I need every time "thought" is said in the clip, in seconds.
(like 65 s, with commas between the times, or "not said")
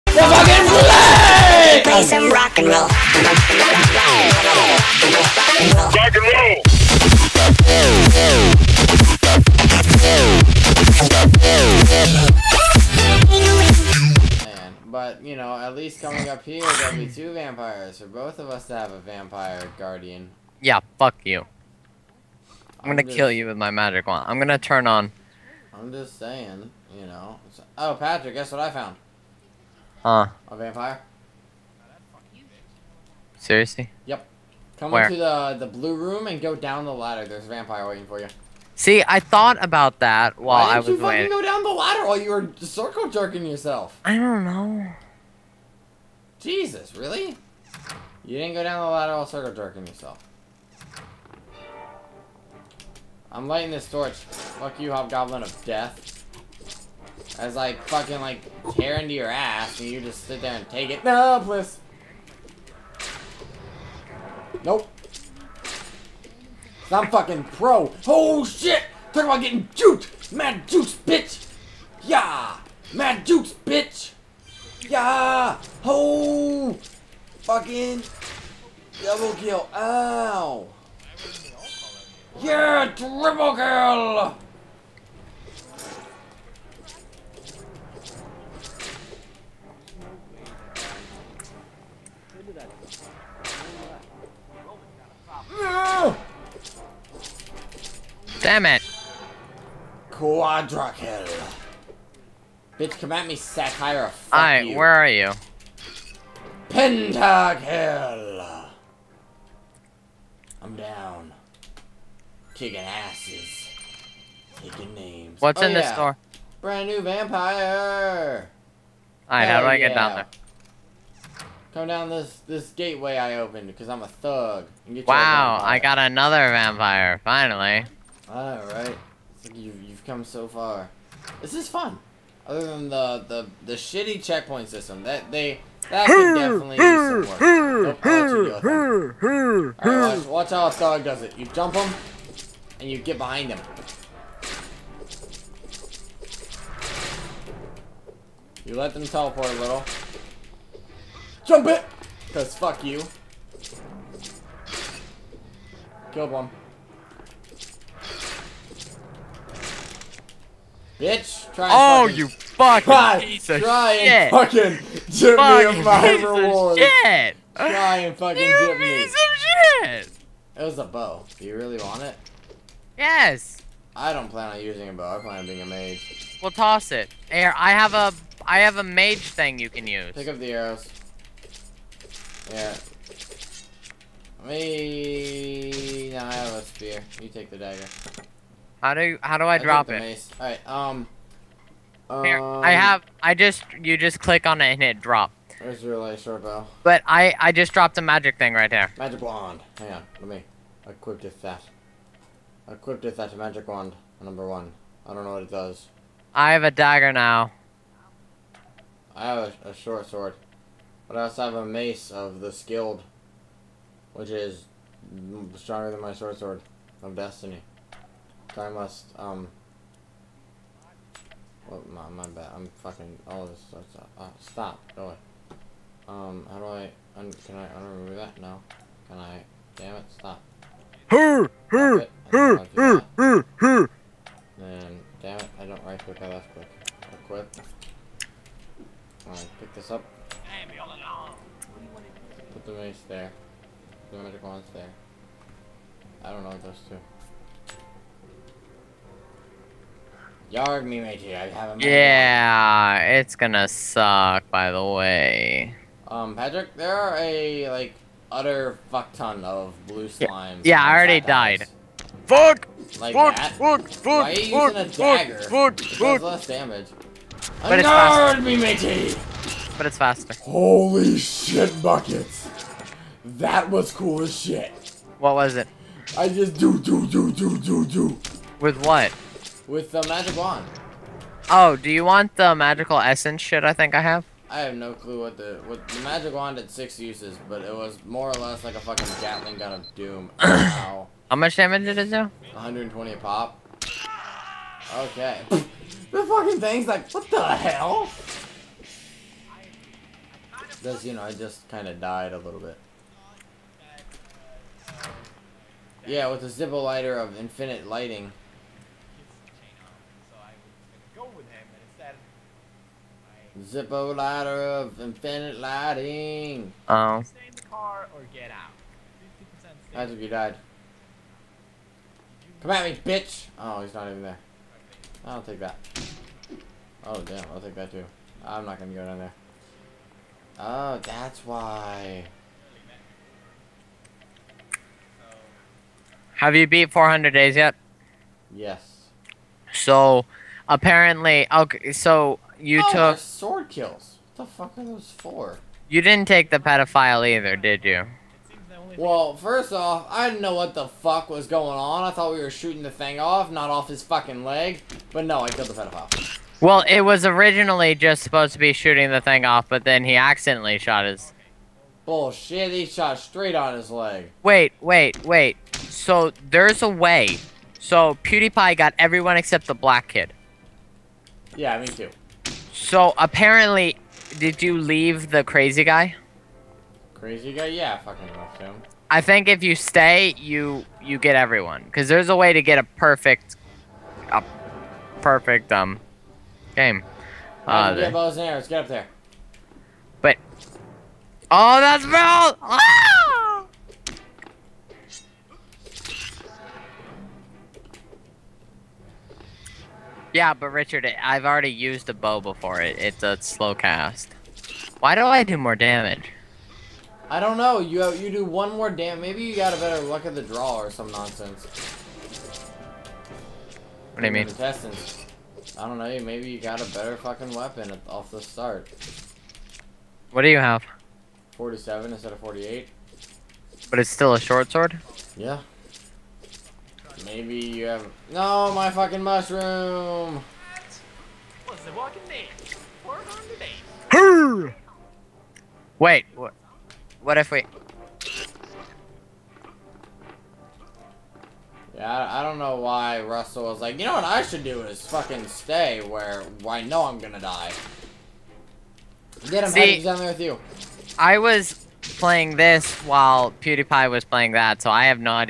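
39 s, 352 s.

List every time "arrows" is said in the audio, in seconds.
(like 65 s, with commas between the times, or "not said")
180 s, 388 s.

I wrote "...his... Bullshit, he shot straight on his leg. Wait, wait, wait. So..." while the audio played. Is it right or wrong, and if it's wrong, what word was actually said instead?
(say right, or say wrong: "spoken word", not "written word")
right.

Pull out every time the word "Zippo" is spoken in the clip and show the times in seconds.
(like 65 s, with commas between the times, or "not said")
306 s, 313 s.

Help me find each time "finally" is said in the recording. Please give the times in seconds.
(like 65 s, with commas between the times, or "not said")
127 s.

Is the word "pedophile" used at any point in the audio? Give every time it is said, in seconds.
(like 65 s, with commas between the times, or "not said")
346 s, 355 s.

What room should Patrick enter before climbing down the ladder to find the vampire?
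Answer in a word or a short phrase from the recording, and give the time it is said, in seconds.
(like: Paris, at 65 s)
The blue room, at 35 s.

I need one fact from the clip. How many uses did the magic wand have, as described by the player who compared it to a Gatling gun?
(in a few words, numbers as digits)
6.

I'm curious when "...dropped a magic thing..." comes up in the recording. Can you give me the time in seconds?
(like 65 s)
197 s.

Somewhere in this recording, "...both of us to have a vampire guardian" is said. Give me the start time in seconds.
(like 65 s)
18 s.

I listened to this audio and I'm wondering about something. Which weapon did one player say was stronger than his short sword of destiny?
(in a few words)
Mace of the skilled.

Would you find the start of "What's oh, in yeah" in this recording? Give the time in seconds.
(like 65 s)
115 s.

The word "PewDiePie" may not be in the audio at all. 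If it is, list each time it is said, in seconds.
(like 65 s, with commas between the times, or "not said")
368 s, 453 s.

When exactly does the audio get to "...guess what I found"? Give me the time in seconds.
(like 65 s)
28 s.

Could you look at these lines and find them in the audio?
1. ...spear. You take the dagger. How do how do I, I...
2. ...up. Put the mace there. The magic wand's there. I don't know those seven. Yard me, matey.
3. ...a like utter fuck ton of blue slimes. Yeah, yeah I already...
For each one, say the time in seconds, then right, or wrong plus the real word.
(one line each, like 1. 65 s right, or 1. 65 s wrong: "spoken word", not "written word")
1. 186 s right
2. 239 s wrong: "two", not "seven"
3. 257 s right.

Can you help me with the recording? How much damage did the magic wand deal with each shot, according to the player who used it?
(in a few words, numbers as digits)
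120.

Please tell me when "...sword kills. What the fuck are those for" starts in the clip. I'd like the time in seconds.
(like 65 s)
343 s.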